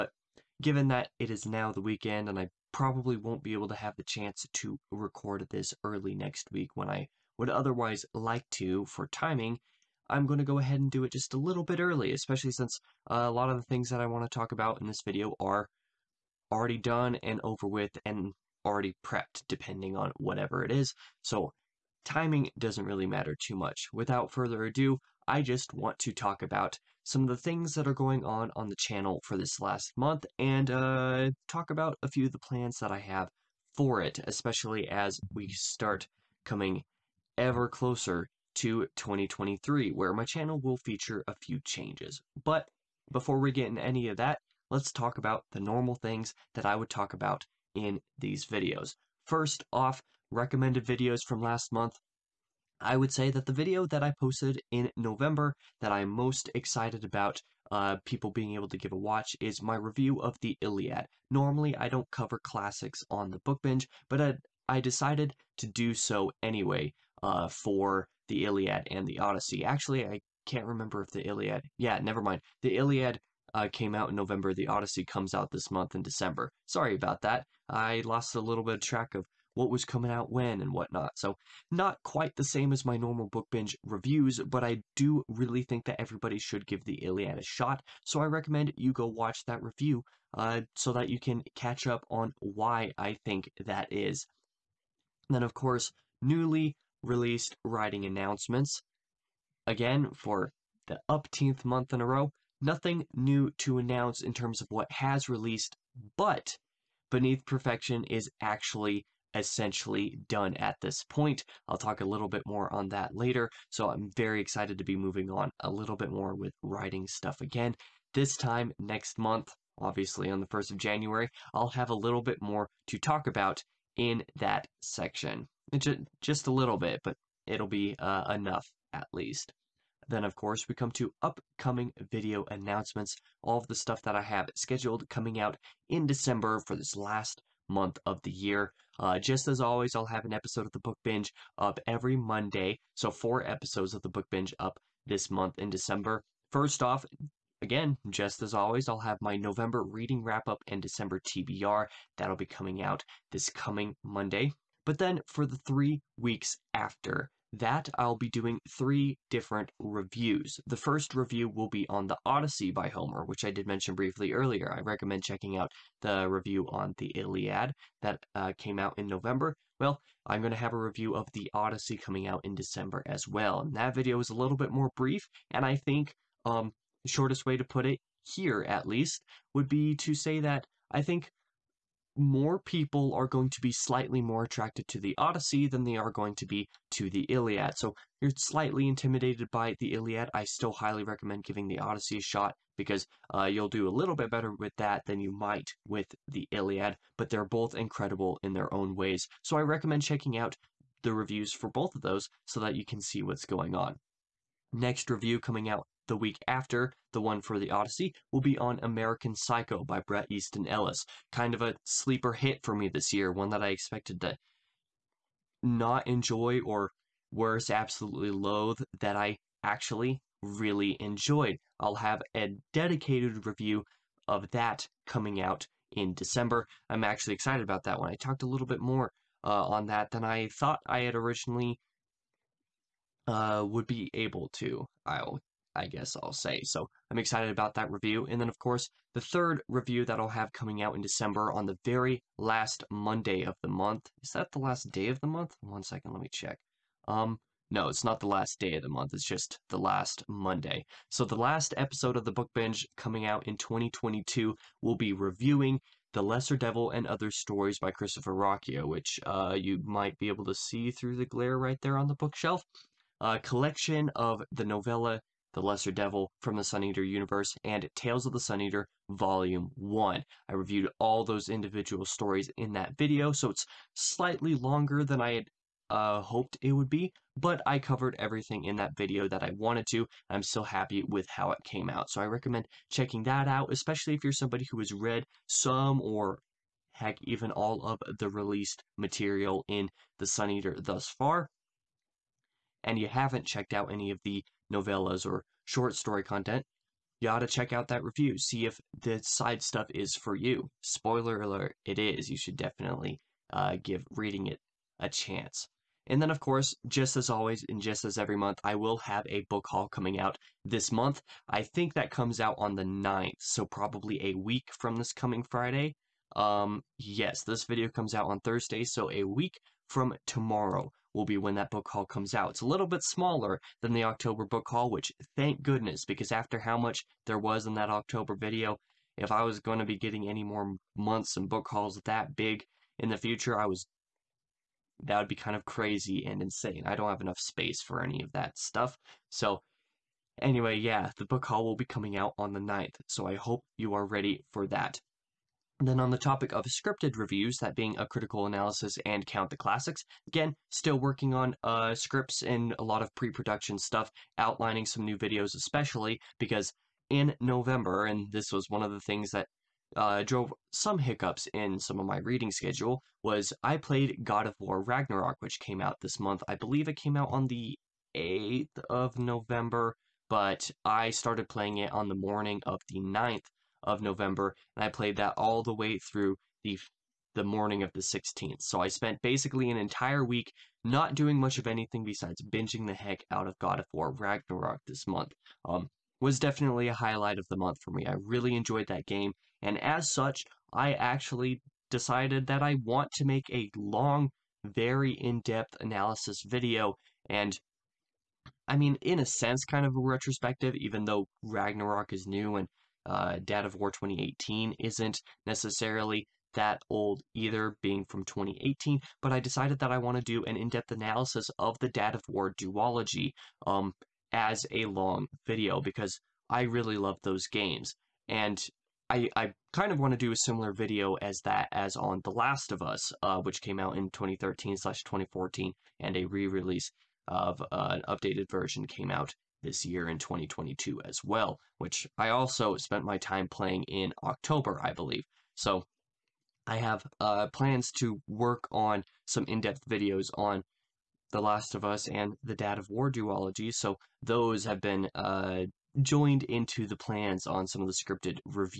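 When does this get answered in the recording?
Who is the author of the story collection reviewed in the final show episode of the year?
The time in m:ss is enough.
4:17.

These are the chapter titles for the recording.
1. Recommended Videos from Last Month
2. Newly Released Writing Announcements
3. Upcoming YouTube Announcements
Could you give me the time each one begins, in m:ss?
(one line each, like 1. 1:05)
1. 0:48
2. 1:34
3. 2:09.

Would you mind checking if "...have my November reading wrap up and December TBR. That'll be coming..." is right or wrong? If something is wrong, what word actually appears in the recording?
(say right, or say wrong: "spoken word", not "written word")
right.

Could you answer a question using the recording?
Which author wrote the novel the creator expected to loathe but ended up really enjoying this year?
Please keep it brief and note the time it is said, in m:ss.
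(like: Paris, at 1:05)
Bret Easton Ellis, at 3:30.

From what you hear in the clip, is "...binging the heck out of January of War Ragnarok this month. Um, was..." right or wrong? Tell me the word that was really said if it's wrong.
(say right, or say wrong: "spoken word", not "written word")
wrong: "God", not "January".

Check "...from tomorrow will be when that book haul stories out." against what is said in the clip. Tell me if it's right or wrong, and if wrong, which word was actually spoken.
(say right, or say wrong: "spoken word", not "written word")
wrong: "comes", not "stories".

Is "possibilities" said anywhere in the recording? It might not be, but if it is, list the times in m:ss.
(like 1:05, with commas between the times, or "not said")
not said.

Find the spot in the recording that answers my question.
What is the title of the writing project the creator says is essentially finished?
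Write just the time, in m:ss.
1:47.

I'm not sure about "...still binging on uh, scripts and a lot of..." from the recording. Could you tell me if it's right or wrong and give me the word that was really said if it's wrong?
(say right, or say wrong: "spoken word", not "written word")
wrong: "working", not "binging".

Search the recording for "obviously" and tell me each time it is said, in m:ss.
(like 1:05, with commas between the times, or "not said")
1:59.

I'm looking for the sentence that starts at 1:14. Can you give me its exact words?
The Odyssey comes out this month in December.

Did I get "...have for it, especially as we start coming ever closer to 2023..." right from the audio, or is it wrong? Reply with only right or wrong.
right.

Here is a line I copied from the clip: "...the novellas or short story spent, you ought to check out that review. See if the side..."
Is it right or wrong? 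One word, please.
wrong.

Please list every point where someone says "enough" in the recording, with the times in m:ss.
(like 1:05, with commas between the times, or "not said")
2:08, 5:37.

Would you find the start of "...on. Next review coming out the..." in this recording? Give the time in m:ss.
3:23.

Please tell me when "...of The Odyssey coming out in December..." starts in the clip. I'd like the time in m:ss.
2:51.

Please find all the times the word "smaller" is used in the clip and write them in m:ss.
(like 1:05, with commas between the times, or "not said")
5:23.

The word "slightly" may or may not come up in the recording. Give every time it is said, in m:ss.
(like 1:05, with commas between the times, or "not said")
3:03, 3:08, 4:33.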